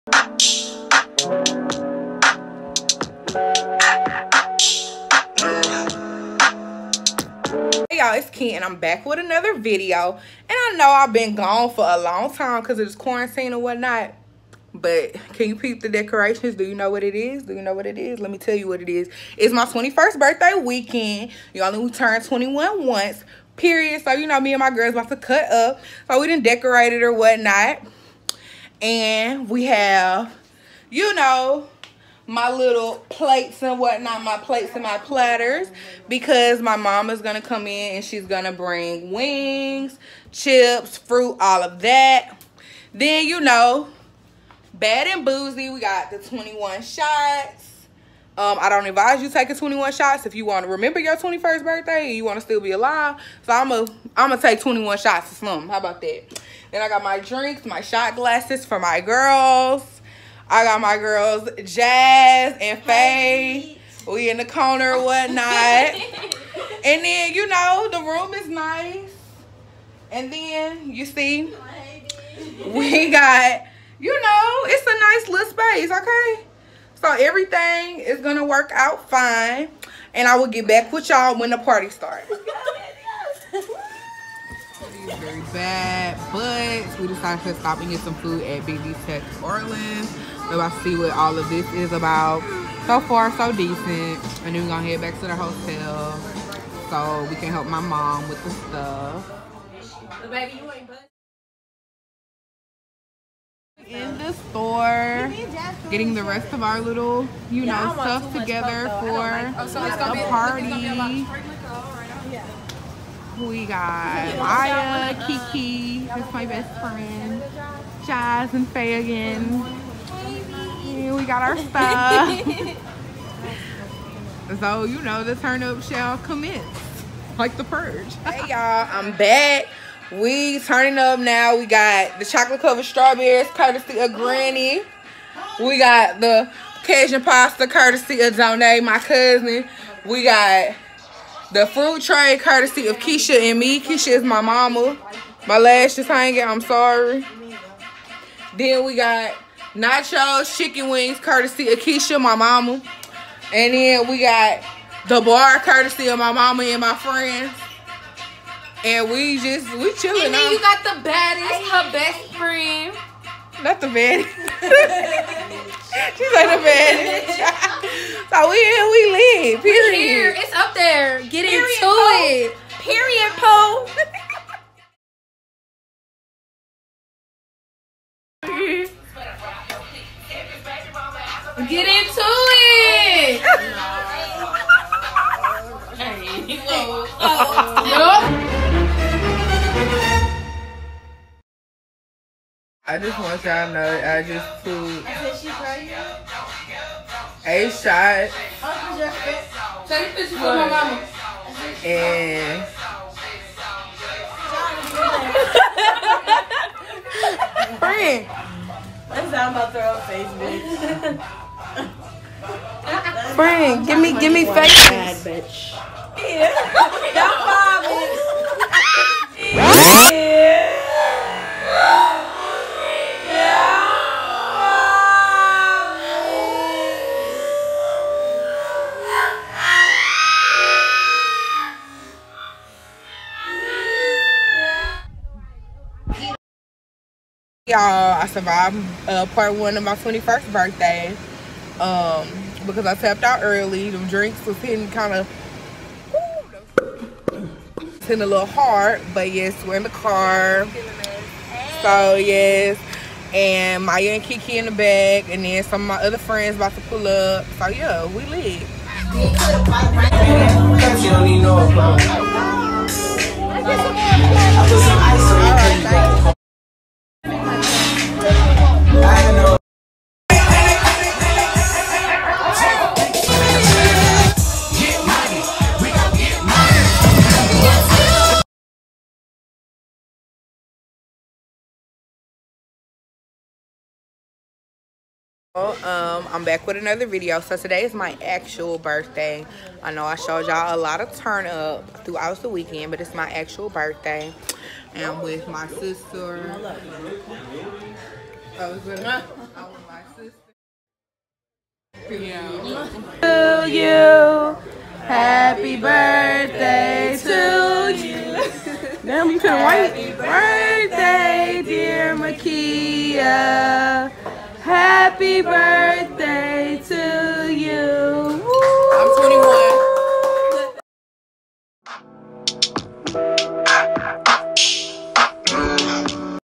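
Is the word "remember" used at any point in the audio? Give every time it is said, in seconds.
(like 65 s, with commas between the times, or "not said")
50 s.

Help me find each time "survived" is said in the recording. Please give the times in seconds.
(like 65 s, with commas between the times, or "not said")
238 s.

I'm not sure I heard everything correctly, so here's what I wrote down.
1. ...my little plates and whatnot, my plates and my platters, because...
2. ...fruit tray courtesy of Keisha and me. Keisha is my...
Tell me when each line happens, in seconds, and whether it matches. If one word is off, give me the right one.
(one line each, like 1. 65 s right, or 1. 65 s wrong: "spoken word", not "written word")
1. 32 s right
2. 141 s right.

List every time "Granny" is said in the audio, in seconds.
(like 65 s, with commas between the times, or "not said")
134 s.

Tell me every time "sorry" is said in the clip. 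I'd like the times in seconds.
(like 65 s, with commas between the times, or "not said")
146 s.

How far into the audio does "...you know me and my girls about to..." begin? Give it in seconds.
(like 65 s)
24 s.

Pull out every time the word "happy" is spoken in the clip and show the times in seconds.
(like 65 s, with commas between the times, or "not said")
305 s, 310 s, 314 s.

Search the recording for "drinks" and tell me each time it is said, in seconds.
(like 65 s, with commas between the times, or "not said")
57 s, 244 s.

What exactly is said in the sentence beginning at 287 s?
So today is my actual birthday.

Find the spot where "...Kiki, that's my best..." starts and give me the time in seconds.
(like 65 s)
115 s.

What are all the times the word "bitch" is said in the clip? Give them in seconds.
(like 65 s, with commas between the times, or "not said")
210 s, 215 s.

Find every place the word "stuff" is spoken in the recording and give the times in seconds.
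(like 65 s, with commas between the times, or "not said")
98 s, 107 s, 121 s.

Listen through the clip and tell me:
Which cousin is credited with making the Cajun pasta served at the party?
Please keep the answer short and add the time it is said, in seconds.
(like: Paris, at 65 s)
Donay, at 138 s.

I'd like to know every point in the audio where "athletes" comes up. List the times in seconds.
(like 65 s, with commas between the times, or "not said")
not said.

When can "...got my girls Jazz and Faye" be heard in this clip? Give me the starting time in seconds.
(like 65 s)
60 s.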